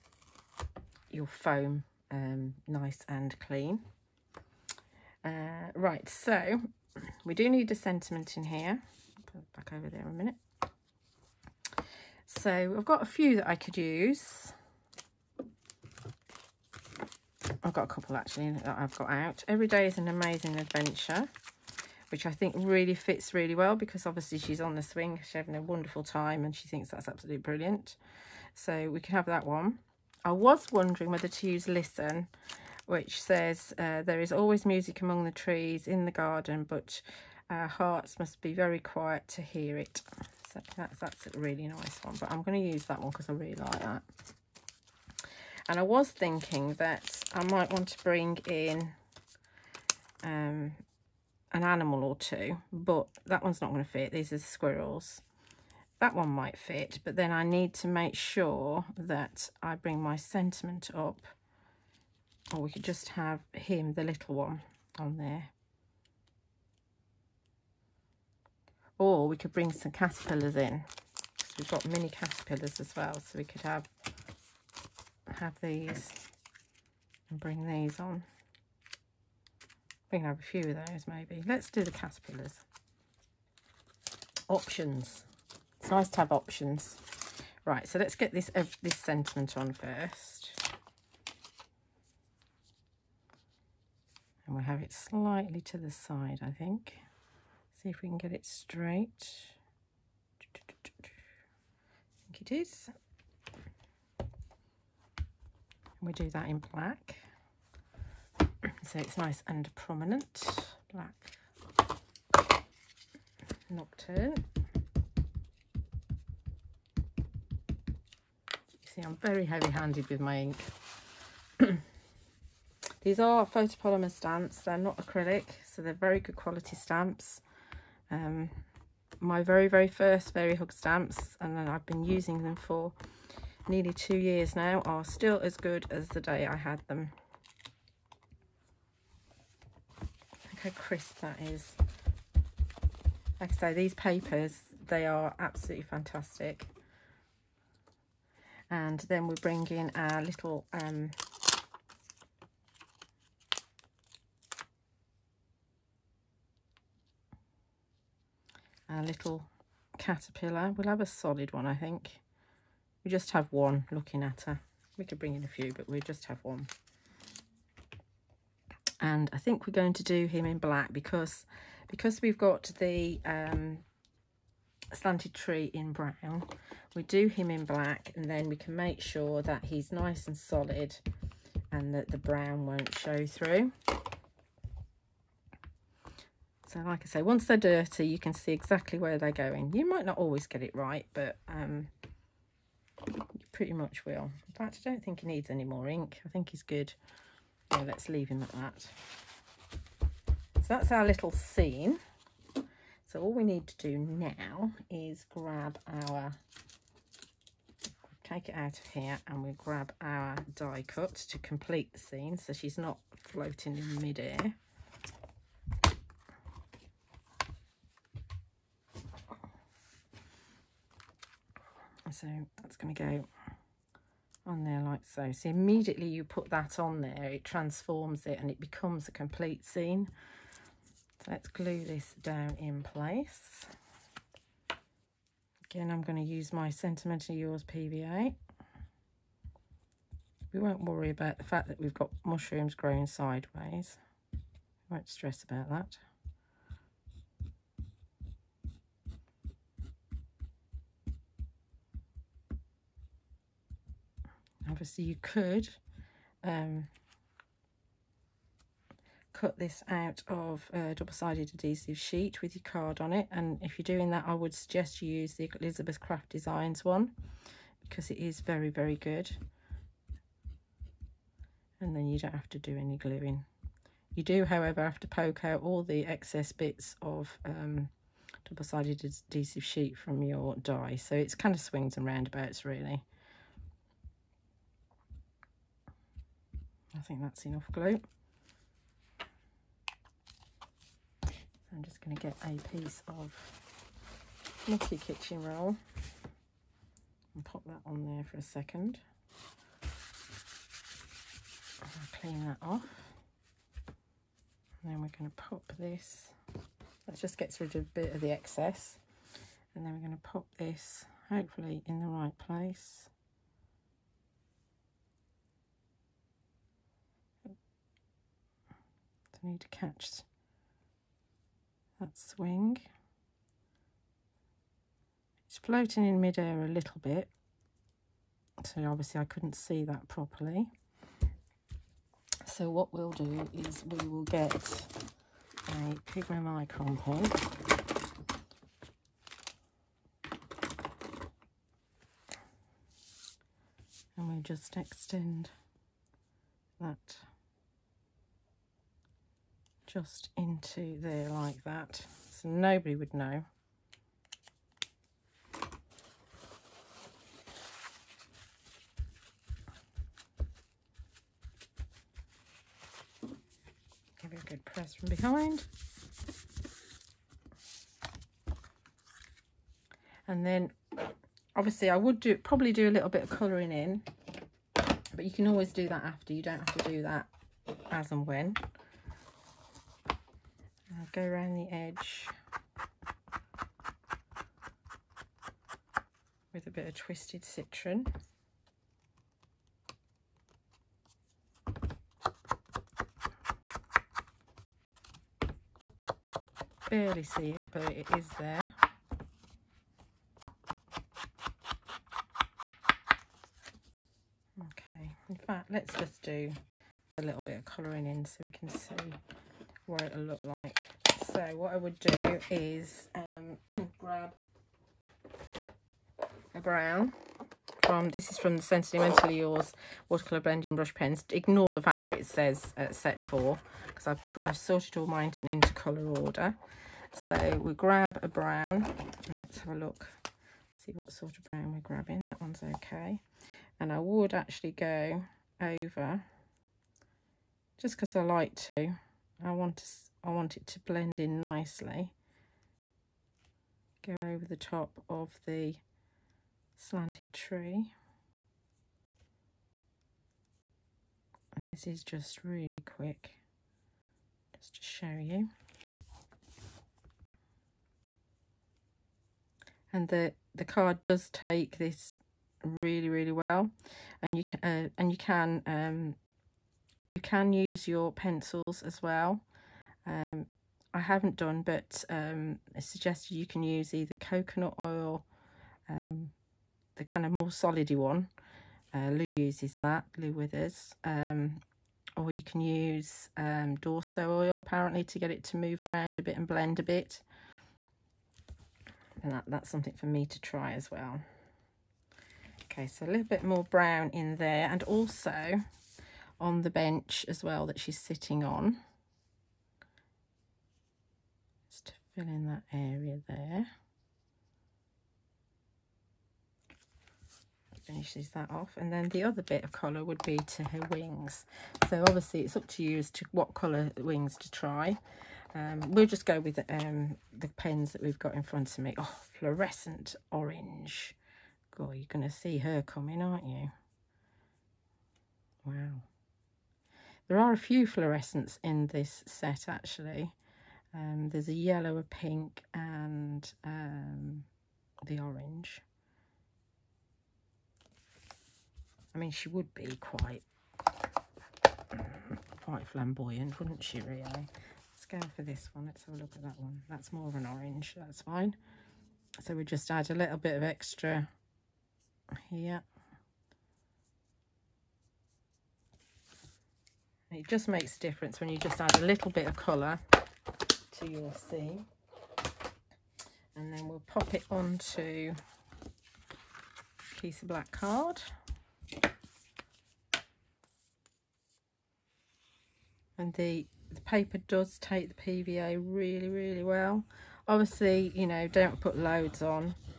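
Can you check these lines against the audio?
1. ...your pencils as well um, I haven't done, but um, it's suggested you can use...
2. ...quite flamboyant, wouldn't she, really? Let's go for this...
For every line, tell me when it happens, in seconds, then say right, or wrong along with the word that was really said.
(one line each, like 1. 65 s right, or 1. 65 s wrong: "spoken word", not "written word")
1. 467 s right
2. 542 s right.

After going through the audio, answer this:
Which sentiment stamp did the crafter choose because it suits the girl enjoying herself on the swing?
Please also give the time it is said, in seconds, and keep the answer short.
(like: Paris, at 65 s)
Every day is an amazing adventure, at 19 s.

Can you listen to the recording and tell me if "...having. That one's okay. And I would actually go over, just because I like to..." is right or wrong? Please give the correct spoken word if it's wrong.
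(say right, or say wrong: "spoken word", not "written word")
wrong: "grabbing", not "having".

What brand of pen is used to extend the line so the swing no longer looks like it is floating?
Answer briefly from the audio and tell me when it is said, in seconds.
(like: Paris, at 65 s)
Pigma Micron, at 336 s.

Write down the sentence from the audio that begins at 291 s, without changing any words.
I'm just going to get a piece of Nicky kitchen roll and pop that on there for a second.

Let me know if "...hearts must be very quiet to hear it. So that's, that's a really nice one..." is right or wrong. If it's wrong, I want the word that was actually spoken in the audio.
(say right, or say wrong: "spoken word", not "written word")
right.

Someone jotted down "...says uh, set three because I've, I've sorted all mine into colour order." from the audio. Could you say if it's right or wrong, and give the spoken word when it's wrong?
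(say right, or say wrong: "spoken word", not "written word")
wrong: "four", not "three".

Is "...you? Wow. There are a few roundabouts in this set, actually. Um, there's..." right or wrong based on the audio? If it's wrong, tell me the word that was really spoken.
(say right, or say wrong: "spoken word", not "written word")
wrong: "fluorescents", not "roundabouts".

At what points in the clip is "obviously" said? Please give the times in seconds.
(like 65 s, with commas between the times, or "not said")
24 s, 254 s, 328 s, 371 s, 512 s, 577 s.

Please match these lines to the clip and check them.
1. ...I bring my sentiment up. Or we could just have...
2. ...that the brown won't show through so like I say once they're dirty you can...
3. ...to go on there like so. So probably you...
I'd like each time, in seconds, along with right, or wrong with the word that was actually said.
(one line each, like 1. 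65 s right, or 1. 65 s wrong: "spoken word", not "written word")
1. 59 s right
2. 181 s right
3. 222 s wrong: "immediately", not "probably".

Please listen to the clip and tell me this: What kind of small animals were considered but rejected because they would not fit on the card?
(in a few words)
Squirrels.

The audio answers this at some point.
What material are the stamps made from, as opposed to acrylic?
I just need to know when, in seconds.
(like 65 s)
123 s.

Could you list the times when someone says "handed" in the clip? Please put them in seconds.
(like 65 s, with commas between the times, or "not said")
119 s.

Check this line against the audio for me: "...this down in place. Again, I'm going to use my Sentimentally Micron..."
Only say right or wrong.
wrong.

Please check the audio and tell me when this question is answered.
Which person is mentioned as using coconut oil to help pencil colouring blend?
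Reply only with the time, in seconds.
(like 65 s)
480 s.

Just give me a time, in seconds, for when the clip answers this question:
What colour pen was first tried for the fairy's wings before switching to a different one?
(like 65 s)
519 s.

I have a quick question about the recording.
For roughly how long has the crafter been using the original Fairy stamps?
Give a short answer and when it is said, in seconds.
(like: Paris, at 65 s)
Nearly two years, at 133 s.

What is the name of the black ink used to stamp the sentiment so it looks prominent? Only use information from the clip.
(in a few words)
Black nocturne.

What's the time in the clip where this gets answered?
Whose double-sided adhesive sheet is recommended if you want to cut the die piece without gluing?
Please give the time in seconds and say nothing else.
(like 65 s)
265 s.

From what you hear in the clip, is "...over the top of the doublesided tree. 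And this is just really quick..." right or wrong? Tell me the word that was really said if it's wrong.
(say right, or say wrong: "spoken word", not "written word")
wrong: "slanted", not "doublesided".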